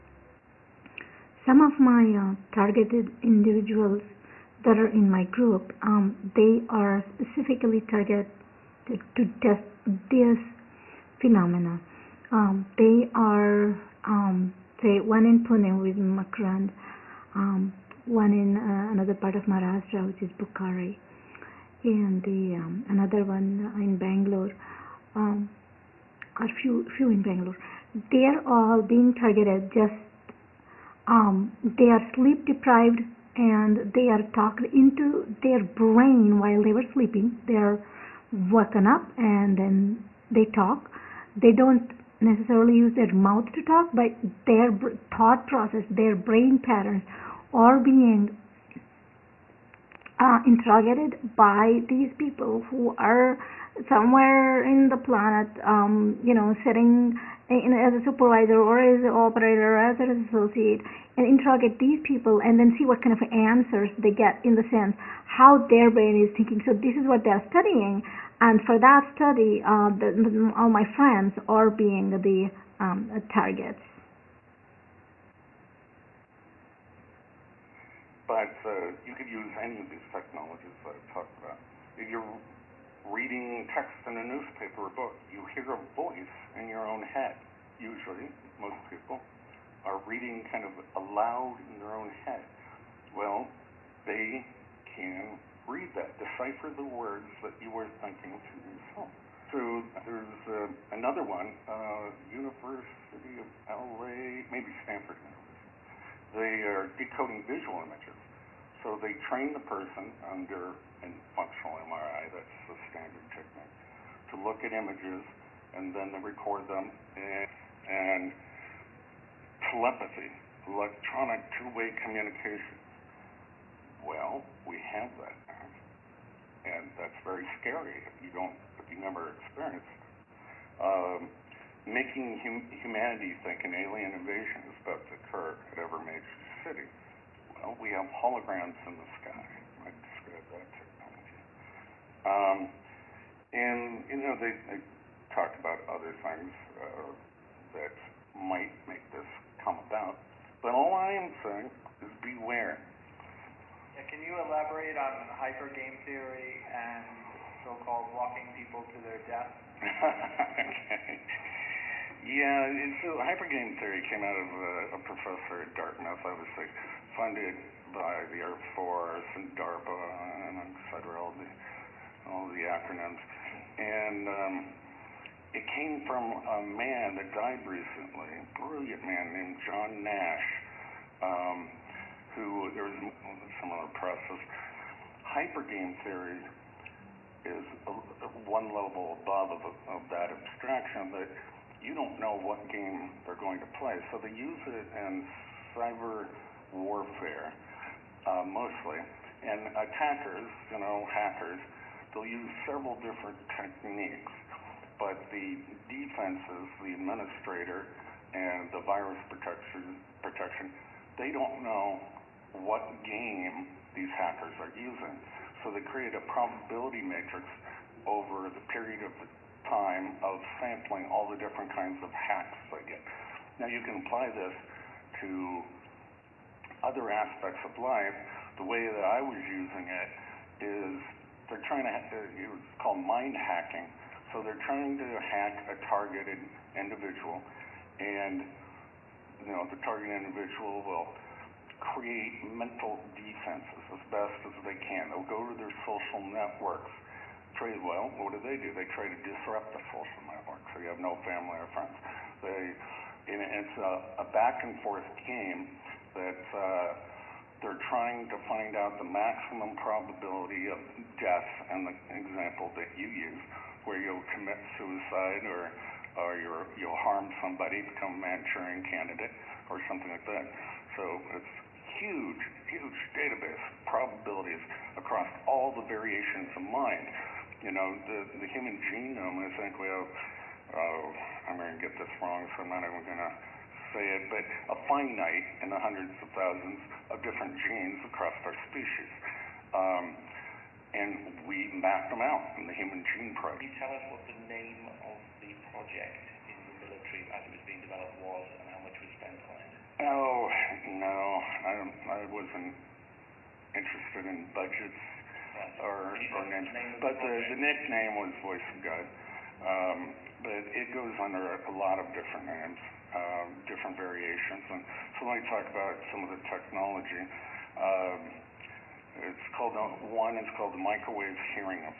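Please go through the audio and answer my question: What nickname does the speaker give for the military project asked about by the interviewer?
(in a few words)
Voice of God.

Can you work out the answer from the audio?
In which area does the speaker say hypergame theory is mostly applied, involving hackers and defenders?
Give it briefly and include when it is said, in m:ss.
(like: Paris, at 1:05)
cyber warfare, at 3:15.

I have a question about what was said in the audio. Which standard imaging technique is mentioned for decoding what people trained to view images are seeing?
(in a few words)
functional MRI.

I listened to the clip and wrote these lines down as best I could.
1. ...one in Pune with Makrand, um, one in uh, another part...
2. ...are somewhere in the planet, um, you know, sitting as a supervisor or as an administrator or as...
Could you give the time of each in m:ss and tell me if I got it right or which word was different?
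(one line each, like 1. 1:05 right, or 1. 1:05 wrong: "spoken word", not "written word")
1. 0:15 right
2. 0:52 wrong: "operator", not "administrator".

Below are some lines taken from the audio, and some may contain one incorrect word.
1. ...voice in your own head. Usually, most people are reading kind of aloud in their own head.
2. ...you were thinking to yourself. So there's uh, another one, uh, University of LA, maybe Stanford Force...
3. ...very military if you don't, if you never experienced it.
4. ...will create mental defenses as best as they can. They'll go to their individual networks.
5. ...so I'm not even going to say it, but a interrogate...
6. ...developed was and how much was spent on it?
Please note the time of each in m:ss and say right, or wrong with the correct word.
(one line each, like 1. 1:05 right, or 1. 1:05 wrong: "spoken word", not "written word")
1. 1:25 right
2. 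1:37 wrong: "They", not "Force"
3. 2:07 wrong: "scary", not "military"
4. 4:00 wrong: "social", not "individual"
5. 4:42 wrong: "finite", not "interrogate"
6. 4:57 right.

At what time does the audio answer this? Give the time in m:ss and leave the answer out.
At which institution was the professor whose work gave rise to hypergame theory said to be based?
2:45.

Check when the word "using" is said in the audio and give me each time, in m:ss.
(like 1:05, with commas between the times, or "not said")
3:34, 3:49.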